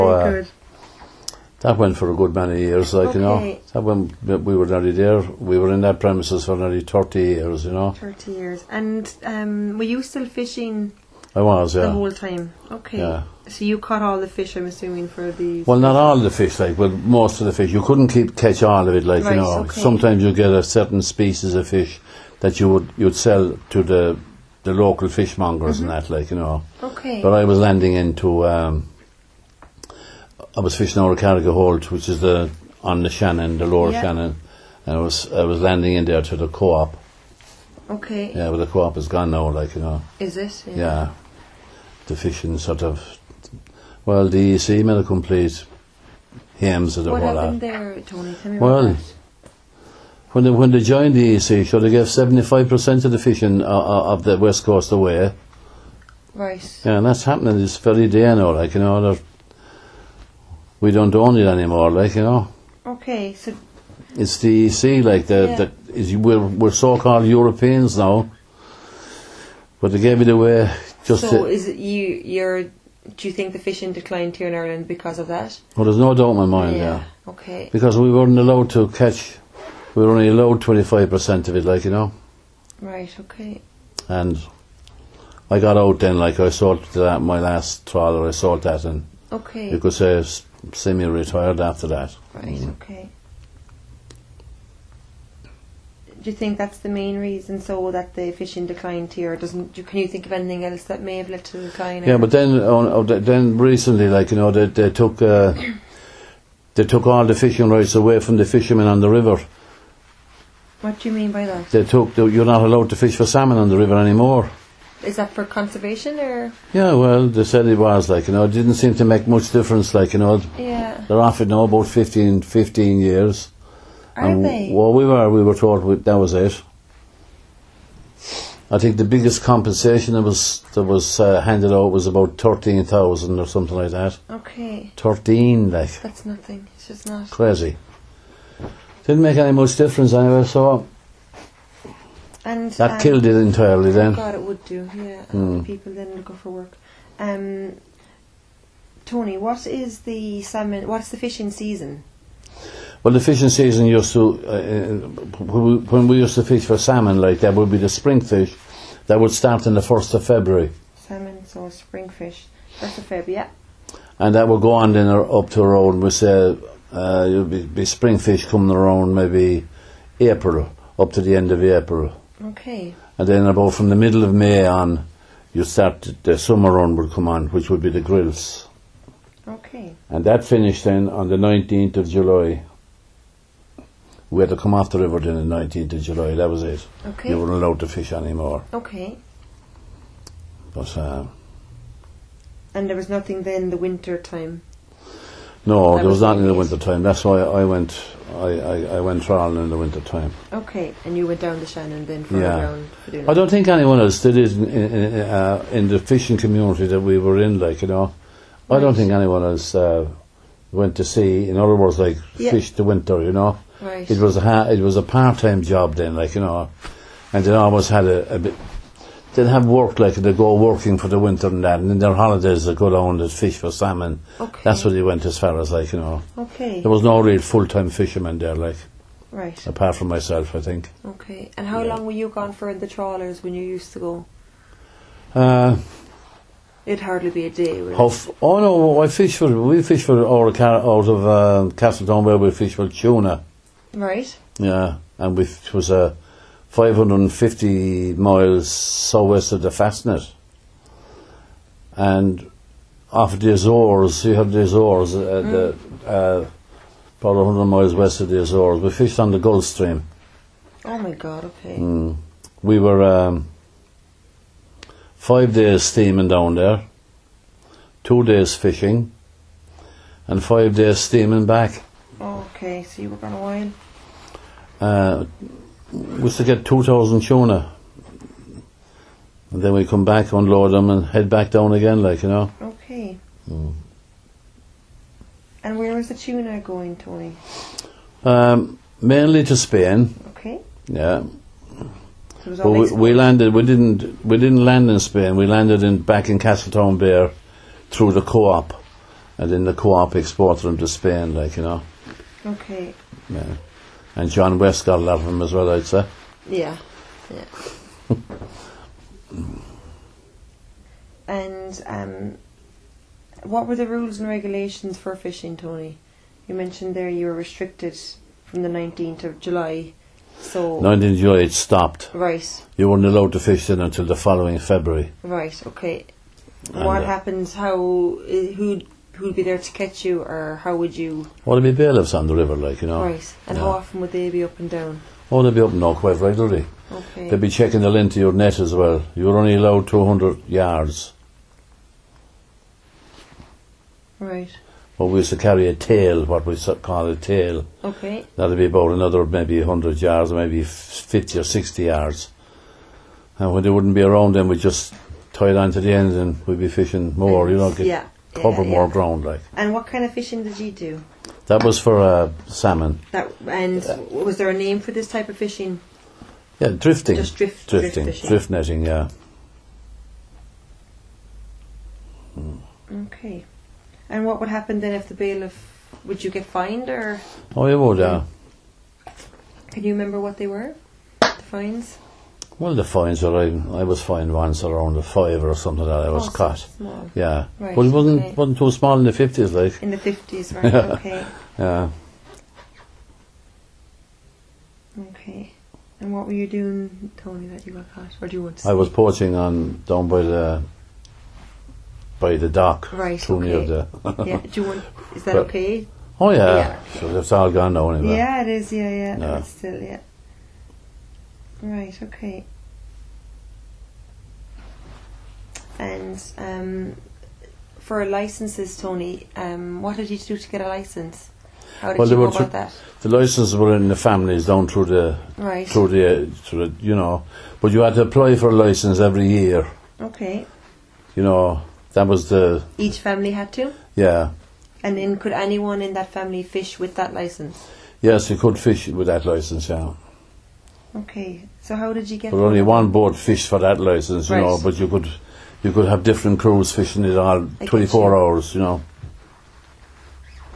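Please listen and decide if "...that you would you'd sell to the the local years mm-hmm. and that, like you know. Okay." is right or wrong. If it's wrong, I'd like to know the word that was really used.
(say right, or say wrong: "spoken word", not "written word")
wrong: "fishmongers", not "years".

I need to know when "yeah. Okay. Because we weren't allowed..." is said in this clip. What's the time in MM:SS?
01:16.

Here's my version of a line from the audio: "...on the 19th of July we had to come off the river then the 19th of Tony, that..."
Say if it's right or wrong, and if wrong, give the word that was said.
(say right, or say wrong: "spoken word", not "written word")
wrong: "July", not "Tony".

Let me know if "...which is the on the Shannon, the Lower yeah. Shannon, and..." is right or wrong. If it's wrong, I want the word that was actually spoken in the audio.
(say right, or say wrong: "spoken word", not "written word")
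right.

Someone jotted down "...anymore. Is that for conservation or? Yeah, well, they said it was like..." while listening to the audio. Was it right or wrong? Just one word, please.
right.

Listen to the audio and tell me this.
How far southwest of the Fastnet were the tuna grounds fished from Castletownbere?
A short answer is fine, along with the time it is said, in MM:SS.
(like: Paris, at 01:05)
550 miles, at 04:06.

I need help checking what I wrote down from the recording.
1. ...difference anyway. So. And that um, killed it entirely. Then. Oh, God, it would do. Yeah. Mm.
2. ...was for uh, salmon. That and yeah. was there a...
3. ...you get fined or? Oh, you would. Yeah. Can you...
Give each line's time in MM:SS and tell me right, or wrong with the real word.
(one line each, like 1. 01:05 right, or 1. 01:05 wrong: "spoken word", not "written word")
1. 02:19 right
2. 06:01 right
3. 06:16 right.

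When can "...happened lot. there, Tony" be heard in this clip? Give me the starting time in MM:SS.
00:47.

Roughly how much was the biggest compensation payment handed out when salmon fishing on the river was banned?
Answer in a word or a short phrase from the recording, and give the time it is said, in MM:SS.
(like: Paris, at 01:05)
13,000, at 02:12.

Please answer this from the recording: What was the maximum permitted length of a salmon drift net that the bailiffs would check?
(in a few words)
200 yards.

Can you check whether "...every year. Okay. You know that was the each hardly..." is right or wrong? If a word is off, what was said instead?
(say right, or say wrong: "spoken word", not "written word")
wrong: "family", not "hardly".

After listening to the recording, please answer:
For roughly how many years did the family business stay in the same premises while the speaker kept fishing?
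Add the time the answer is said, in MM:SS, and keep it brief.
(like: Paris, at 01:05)
30 years, at 00:06.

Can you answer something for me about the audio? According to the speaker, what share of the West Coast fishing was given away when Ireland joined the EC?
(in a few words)
75%.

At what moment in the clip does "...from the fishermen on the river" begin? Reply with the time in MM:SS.
01:48.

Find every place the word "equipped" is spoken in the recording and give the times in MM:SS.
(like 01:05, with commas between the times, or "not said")
not said.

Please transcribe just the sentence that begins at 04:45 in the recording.
And where was the tuna going, Tony?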